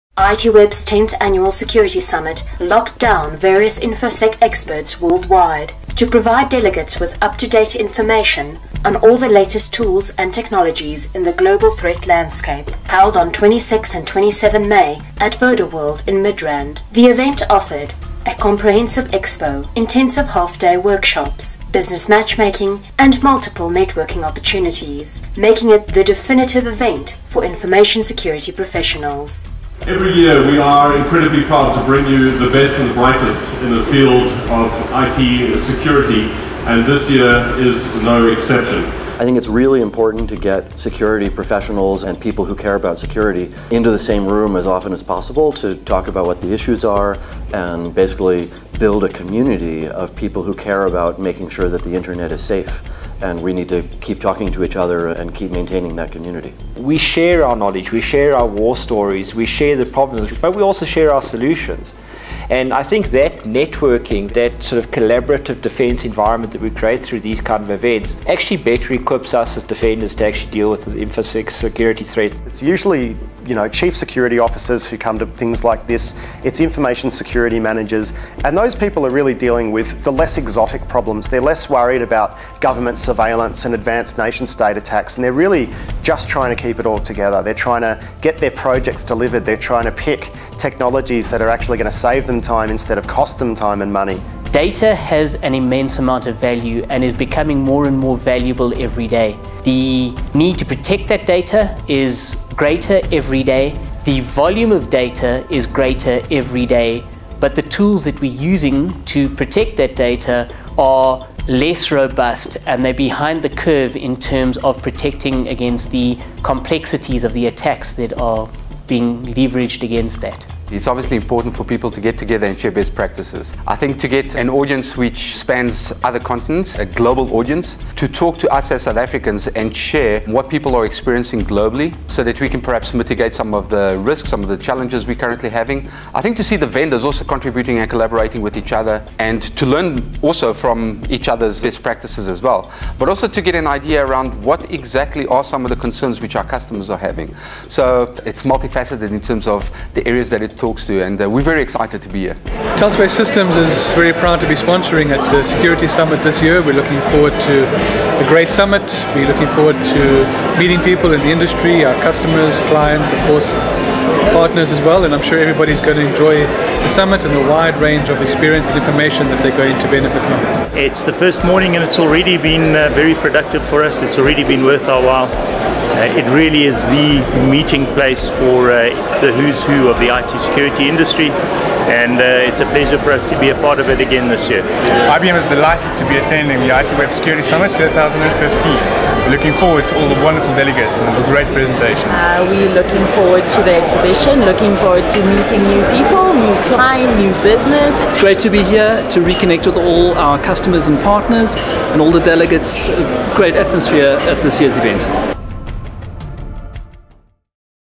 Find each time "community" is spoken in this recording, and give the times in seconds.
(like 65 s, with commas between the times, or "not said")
49 s, 56 s.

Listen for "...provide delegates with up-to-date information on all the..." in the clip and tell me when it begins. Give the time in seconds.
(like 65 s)
6 s.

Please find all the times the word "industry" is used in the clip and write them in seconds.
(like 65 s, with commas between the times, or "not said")
161 s, 180 s.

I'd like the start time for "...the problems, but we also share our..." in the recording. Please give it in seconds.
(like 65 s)
59 s.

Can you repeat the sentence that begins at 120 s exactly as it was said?
It's obviously important for people to get together and share best practices.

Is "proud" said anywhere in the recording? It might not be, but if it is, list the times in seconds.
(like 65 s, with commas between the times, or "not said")
31 s, 154 s.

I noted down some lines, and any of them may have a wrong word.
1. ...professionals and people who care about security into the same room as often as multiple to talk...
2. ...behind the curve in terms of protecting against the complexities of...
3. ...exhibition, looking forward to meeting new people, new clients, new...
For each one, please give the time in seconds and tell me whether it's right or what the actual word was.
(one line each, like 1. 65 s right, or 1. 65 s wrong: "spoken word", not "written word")
1. 41 s wrong: "possible", not "multiple"
2. 112 s right
3. 193 s right.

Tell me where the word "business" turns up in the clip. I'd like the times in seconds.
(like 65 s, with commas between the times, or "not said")
21 s, 197 s.